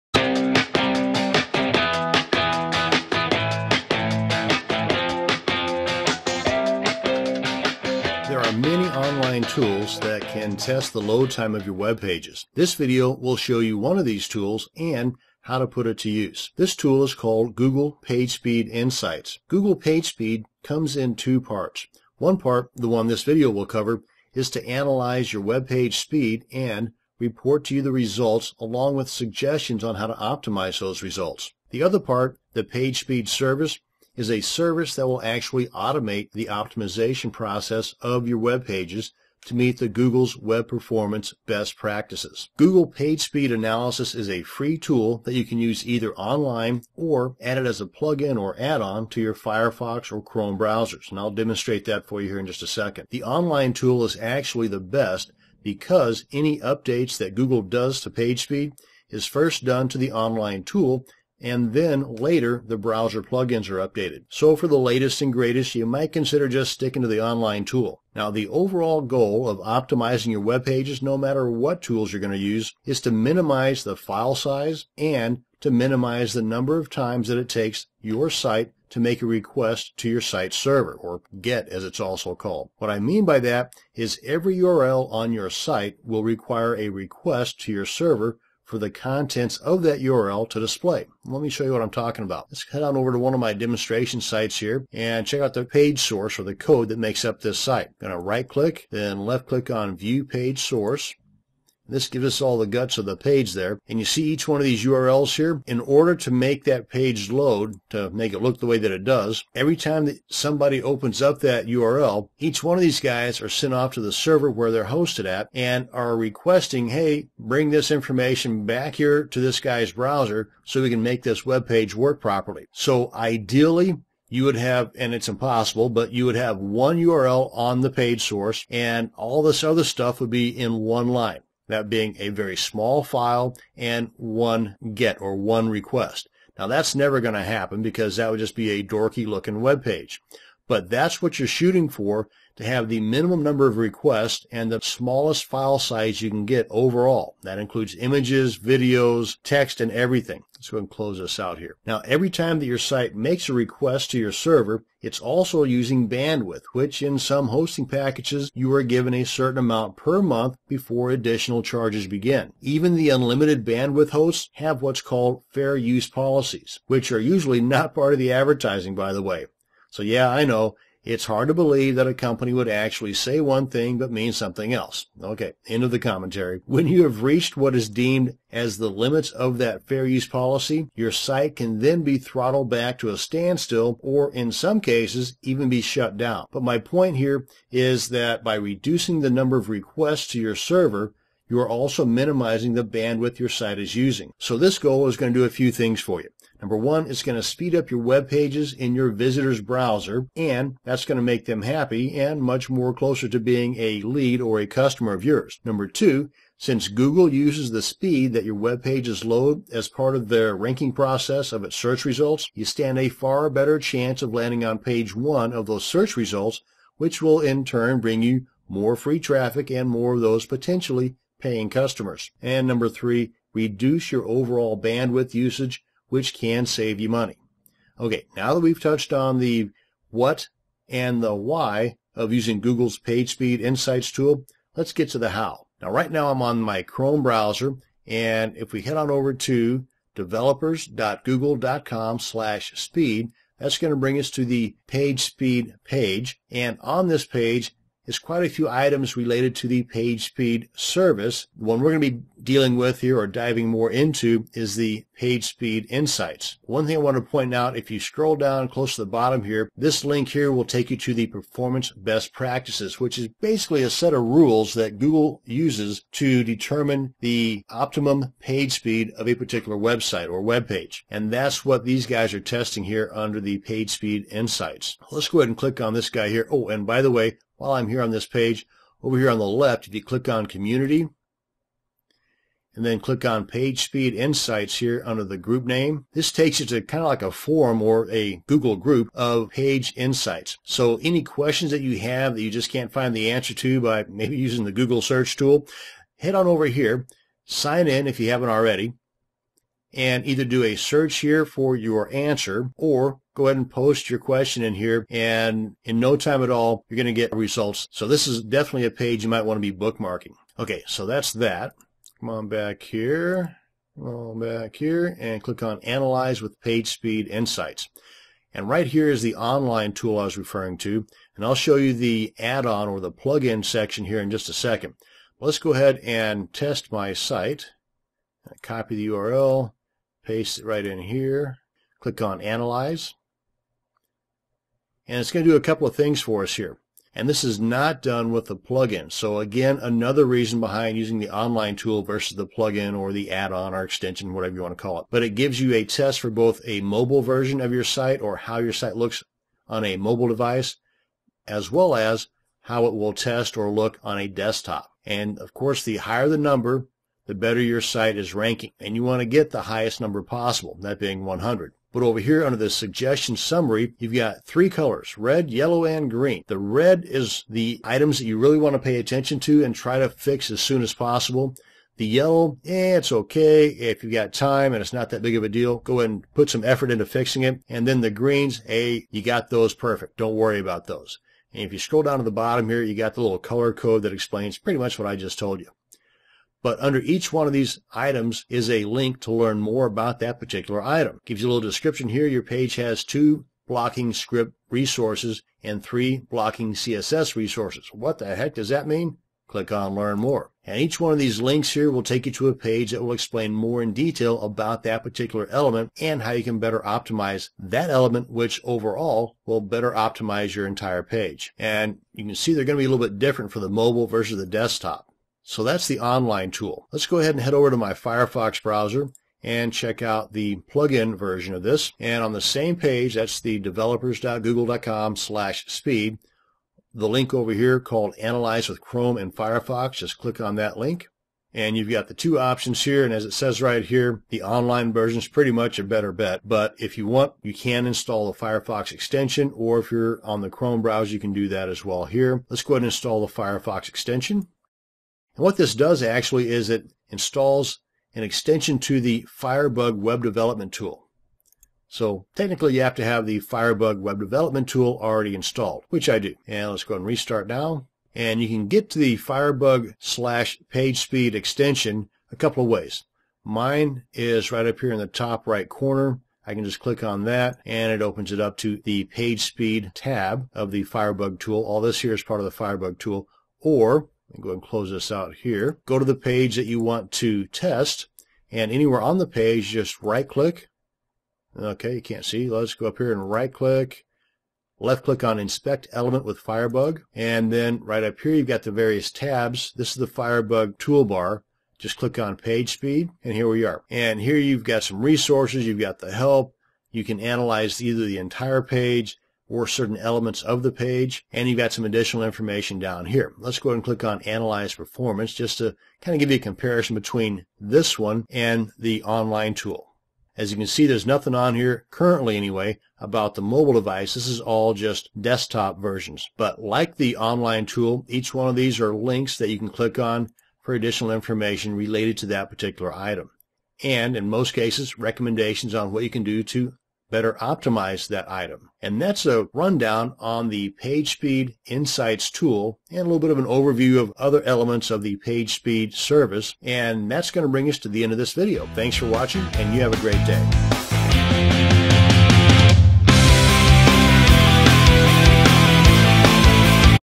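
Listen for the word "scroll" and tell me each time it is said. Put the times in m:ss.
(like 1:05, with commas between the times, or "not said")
4:17, 6:21.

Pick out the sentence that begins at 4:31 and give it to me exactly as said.
And that's what these guys are testing here under the page speed insights.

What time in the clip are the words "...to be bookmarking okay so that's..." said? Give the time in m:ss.
5:09.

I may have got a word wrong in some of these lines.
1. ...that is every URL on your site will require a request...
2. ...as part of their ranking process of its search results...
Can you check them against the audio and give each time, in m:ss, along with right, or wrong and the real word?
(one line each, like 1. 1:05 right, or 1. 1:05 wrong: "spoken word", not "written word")
1. 1:23 right
2. 3:29 right.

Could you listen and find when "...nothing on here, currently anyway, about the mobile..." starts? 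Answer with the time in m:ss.
8:31.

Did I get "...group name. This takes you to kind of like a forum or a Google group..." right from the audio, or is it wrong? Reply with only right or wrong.
right.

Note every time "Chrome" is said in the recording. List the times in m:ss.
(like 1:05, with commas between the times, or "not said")
0:50, 3:56, 7:08, 7:20.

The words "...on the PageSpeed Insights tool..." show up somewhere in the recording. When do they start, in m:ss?
8:50.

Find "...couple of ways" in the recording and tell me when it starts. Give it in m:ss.
7:42.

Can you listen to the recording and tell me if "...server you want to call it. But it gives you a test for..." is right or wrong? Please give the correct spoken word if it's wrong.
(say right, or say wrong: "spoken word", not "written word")
wrong: "whatever", not "server".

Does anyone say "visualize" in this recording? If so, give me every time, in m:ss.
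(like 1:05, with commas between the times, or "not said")
not said.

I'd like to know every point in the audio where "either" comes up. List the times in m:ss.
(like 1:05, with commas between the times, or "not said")
0:45, 5:00, 8:17.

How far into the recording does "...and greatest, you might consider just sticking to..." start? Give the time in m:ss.
1:05.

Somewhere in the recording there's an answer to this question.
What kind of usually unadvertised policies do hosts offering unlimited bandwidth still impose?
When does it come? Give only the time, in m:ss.
2:45.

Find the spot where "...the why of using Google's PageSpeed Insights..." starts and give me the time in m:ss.
3:51.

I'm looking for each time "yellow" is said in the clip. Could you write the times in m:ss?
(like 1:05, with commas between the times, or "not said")
6:05, 6:12.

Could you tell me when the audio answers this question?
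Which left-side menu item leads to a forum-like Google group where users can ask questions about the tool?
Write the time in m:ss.
4:40.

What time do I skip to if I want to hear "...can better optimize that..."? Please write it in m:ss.
6:46.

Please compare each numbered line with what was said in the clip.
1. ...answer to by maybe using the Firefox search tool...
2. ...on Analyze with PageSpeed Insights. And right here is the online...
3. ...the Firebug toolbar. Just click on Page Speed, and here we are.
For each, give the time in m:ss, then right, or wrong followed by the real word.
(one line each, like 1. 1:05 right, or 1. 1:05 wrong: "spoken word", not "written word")
1. 4:53 wrong: "Google", not "Firefox"
2. 5:15 right
3. 8:09 right.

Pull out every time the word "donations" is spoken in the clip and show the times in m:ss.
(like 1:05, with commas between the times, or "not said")
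not said.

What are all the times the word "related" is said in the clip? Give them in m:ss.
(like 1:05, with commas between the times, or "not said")
4:09, 8:41.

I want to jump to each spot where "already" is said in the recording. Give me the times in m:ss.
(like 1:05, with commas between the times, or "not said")
4:58, 7:35.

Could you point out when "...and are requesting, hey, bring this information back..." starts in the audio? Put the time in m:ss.
1:55.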